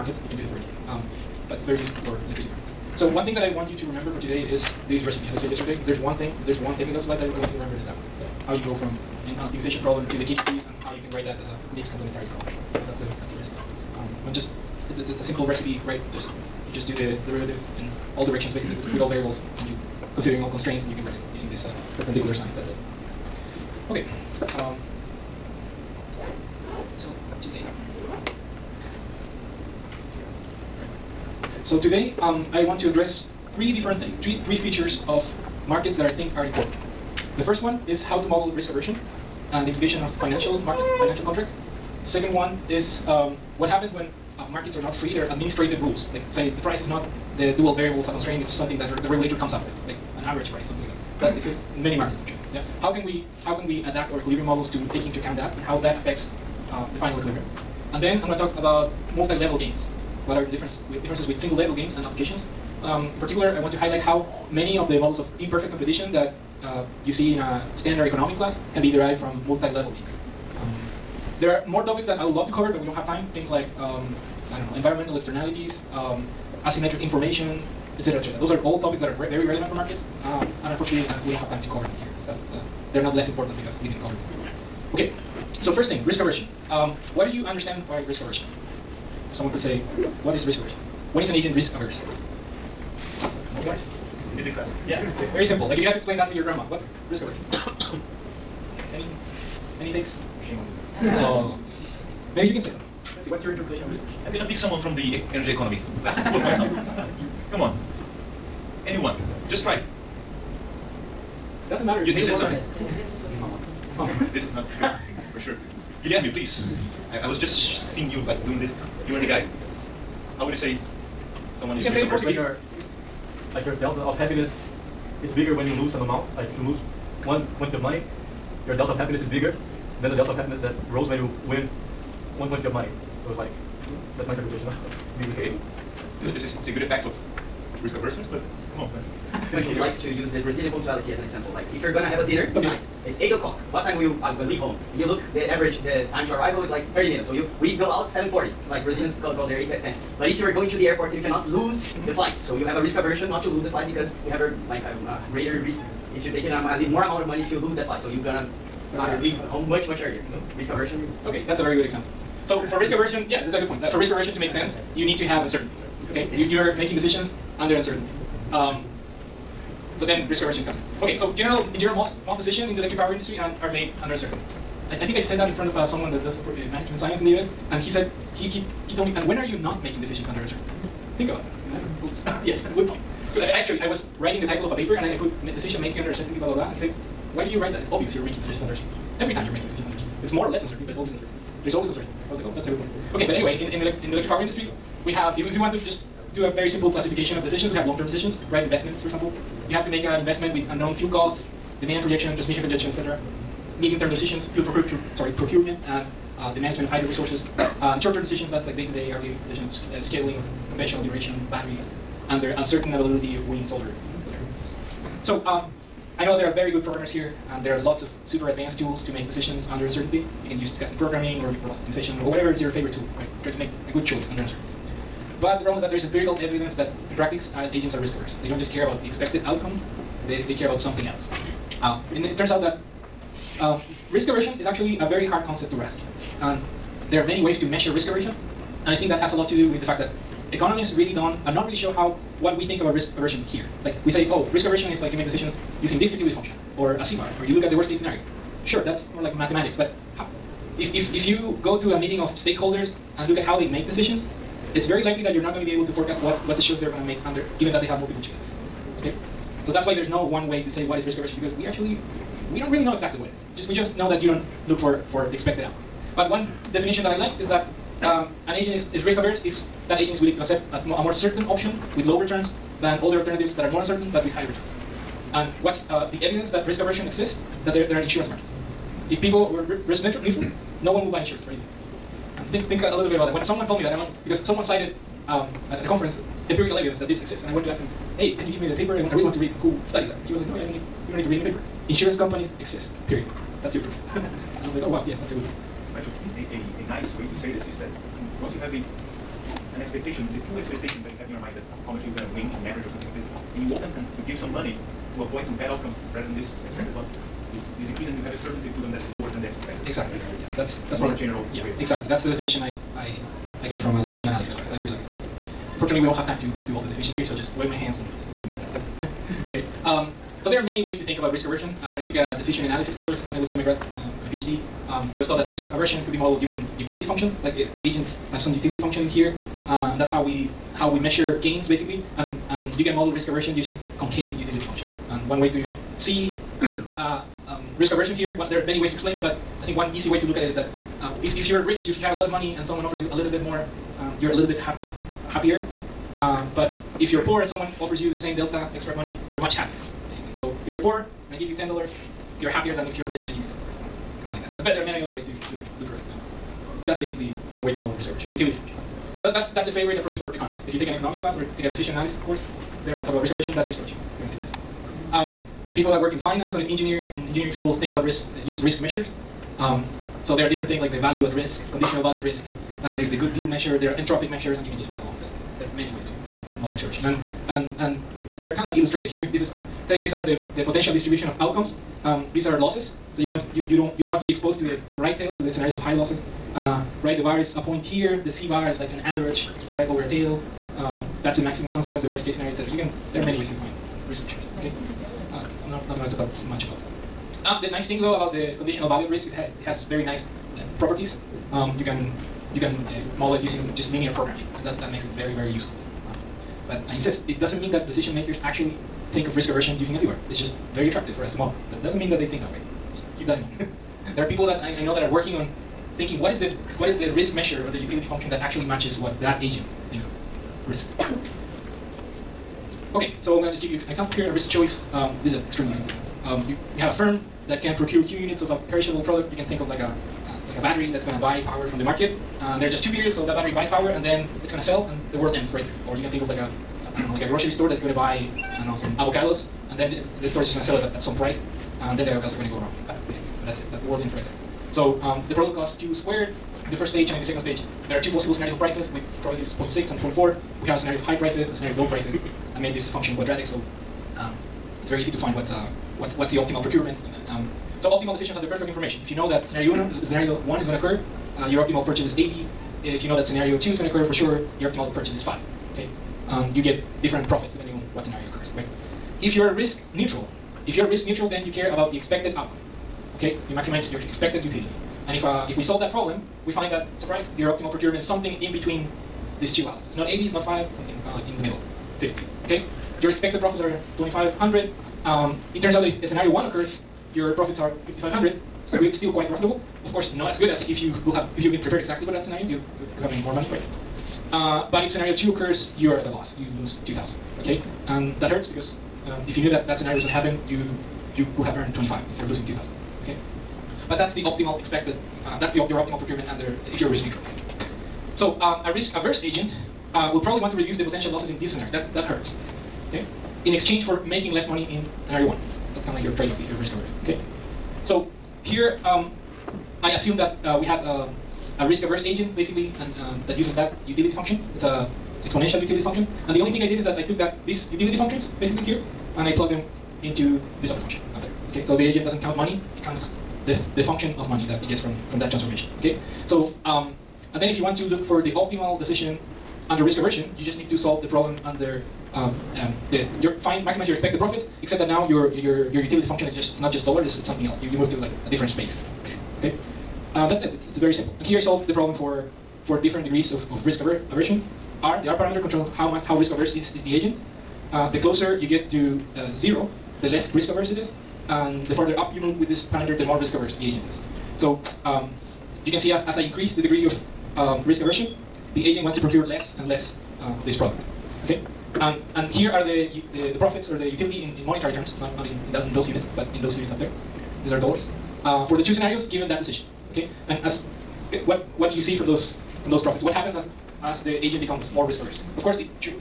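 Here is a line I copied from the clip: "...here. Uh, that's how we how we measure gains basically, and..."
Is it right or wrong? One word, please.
right.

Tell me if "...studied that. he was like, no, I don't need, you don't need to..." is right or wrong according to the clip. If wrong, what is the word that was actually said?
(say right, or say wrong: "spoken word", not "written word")
right.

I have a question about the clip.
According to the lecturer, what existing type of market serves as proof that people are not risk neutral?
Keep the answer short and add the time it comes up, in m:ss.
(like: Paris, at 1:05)
insurance markets, at 4:38.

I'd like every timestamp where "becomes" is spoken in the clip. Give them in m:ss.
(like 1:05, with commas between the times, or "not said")
9:44.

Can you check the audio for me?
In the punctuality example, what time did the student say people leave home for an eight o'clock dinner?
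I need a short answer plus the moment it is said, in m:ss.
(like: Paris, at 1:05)
7:40, at 2:28.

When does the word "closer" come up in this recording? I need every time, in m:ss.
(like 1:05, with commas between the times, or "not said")
9:18.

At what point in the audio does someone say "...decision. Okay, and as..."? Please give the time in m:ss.
9:39.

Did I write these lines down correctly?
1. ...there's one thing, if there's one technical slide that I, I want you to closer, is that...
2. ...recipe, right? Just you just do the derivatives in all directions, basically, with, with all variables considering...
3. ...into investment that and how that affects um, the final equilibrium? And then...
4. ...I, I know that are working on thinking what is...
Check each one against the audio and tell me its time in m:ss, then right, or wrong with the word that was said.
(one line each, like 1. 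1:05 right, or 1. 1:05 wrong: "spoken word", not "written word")
1. 0:05 wrong: "remember", not "closer"
2. 0:15 right
3. 0:55 wrong: "account", not "investment"
4. 6:54 right.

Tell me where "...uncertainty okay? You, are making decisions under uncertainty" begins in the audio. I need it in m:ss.
2:45.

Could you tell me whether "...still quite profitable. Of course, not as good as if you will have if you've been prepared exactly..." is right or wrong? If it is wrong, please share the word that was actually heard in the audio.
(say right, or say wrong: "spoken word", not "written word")
right.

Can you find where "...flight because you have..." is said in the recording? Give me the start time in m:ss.
2:33.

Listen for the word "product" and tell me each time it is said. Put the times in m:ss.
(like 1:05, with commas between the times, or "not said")
7:09, 7:25, 9:30.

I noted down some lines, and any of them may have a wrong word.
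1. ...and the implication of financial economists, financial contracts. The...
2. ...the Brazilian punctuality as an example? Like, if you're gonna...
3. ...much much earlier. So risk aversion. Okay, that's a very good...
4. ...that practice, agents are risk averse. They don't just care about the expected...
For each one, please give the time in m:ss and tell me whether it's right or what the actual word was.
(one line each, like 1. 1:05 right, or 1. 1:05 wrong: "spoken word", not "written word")
1. 0:39 wrong: "markets", not "economists"
2. 2:20 right
3. 2:39 right
4. 3:46 right.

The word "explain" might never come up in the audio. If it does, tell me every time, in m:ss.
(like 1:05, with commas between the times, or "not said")
1:35, 5:38.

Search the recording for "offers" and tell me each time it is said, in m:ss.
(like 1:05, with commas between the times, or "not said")
5:42, 5:47.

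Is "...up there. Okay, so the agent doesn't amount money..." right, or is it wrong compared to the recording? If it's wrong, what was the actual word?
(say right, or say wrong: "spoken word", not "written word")
wrong: "count", not "amount".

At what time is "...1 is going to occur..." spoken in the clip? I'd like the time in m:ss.
7:40.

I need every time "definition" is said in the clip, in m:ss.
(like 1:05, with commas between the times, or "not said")
4:26, 5:12, 5:16.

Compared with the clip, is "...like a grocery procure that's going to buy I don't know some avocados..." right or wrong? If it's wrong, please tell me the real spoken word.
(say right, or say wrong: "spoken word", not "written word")
wrong: "store", not "procure".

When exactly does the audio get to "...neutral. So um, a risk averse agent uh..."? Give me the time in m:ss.
8:27.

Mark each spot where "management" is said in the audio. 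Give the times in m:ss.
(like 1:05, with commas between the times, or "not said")
2:56, 3:26.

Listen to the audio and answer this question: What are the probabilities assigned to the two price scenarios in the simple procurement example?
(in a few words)
0.6 and 0.4.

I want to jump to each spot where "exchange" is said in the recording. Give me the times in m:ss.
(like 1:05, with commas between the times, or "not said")
8:33.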